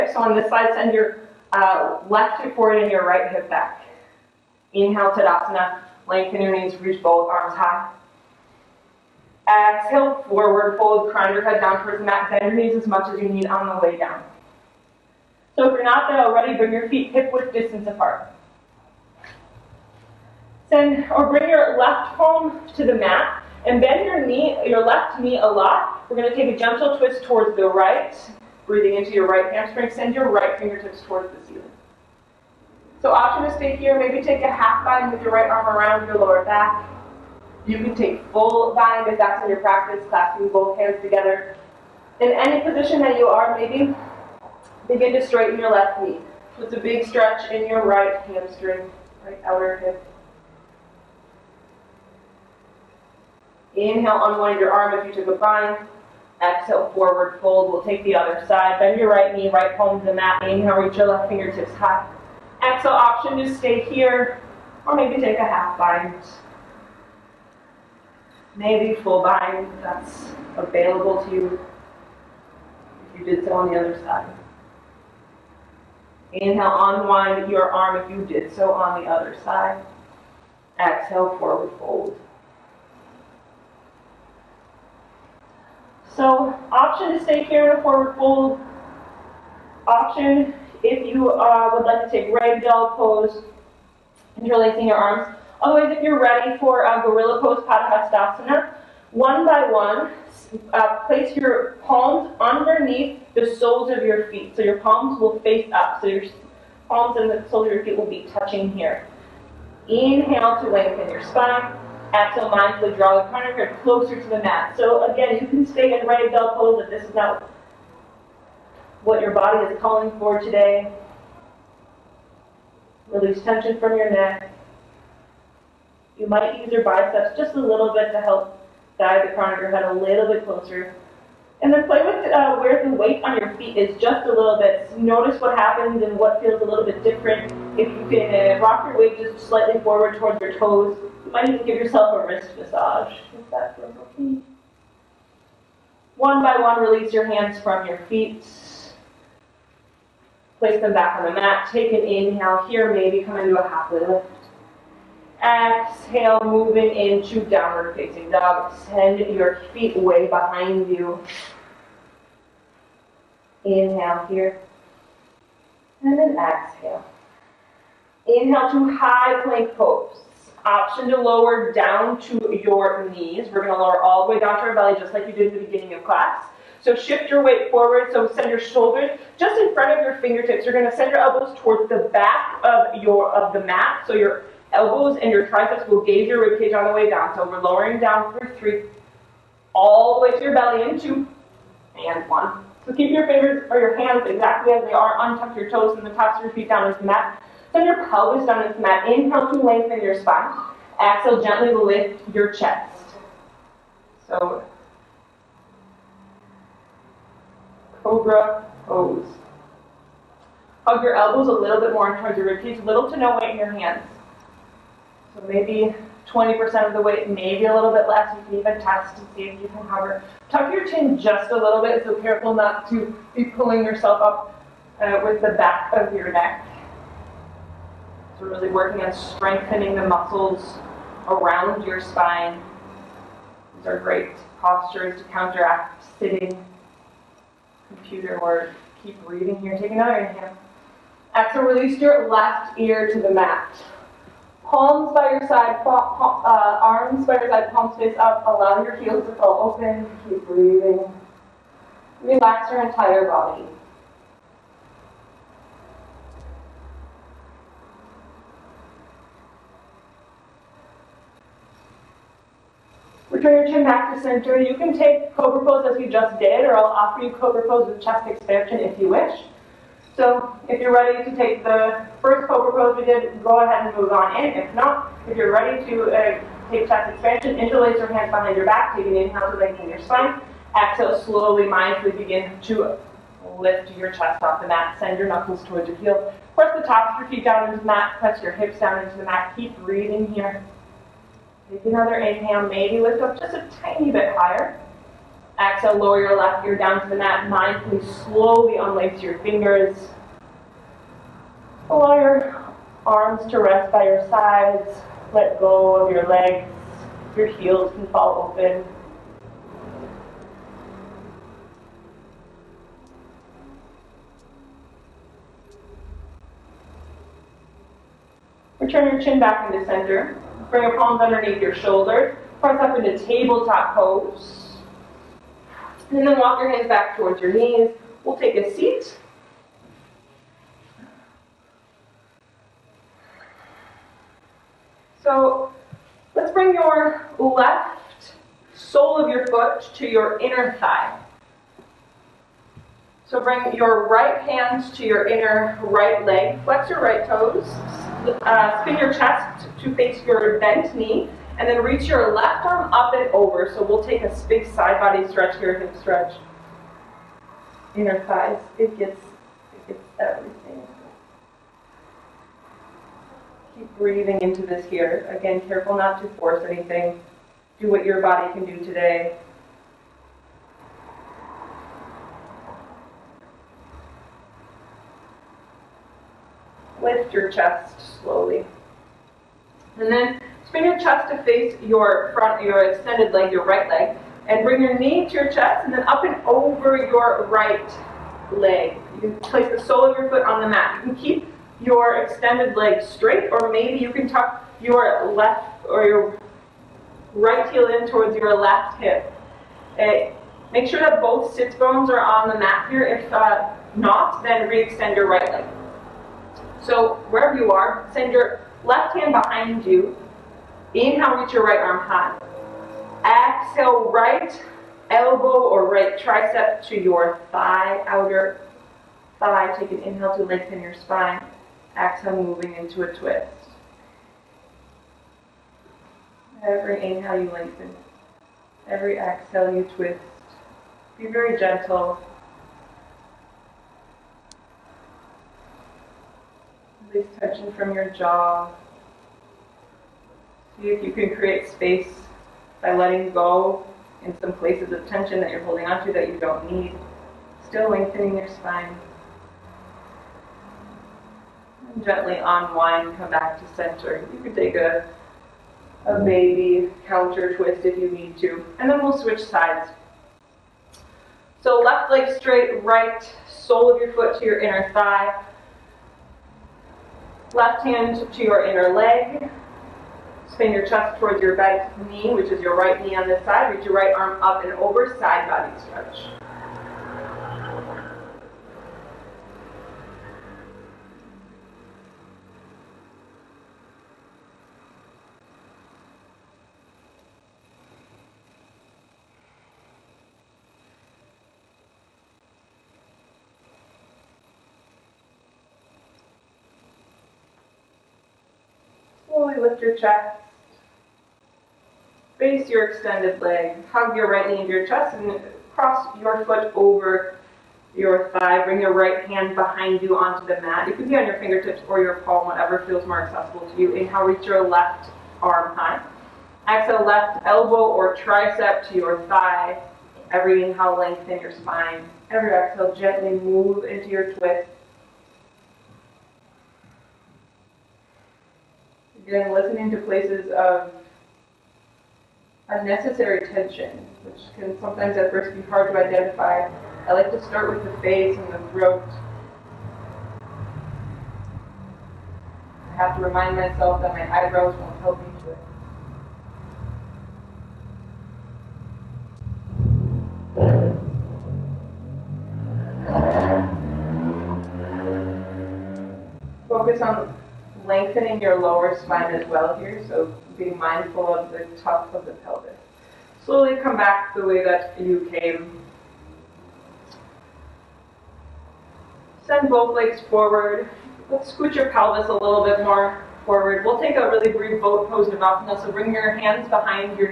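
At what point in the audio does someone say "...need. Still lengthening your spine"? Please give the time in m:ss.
7:26.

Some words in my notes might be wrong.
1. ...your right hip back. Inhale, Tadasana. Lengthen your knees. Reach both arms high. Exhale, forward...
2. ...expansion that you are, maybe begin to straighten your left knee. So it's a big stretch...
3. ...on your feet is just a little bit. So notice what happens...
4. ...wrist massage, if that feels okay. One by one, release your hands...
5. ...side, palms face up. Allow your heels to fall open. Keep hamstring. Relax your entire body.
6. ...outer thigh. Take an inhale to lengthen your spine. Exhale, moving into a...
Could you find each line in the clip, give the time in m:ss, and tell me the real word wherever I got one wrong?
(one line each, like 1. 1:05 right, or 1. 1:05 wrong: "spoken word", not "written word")
1. 0:02 right
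2. 0:42 wrong: "position", not "expansion"
3. 2:13 right
4. 2:22 right
5. 4:07 wrong: "breathing", not "hamstring"
6. 6:58 right.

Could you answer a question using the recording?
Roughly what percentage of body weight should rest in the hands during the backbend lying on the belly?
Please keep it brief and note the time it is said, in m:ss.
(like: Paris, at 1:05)
20%, at 3:36.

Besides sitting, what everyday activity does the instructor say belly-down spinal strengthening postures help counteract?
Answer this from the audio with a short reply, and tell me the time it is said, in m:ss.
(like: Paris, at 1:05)
Computer work, at 3:57.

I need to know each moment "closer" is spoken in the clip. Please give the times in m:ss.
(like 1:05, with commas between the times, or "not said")
1:53, 2:10.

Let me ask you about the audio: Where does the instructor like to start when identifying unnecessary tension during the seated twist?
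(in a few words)
The face and the throat.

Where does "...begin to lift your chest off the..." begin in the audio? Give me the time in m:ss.
4:42.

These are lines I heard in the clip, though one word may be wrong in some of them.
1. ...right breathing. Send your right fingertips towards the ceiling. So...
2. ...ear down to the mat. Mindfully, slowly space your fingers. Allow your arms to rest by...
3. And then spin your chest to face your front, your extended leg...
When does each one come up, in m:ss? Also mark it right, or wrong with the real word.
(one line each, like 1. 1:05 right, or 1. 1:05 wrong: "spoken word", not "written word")
1. 0:29 wrong: "hamstring", not "breathing"
2. 4:56 wrong: "unlace", not "space"
3. 6:19 right.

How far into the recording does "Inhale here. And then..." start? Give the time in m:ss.
2:43.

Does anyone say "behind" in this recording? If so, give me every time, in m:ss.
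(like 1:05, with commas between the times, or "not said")
2:40, 4:38, 6:49, 8:29, 9:36.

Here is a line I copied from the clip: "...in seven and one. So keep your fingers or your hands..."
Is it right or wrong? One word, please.
wrong.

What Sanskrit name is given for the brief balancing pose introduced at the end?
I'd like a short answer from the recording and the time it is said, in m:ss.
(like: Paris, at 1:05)
Navasana, at 9:35.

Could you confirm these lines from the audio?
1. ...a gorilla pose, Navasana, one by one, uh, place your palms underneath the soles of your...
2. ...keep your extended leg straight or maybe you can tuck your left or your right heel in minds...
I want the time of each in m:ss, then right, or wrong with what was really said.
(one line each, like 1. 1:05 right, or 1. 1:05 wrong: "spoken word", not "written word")
1. 1:36 wrong: "Padahastasana", not "Navasana"
2. 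6:31 wrong: "towards", not "minds".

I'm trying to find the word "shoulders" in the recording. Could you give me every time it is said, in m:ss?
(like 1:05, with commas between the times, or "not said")
2:58, 5:21.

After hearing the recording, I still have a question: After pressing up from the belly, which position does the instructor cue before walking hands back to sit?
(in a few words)
Tabletop pose.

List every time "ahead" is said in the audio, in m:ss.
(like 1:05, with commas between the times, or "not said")
4:33.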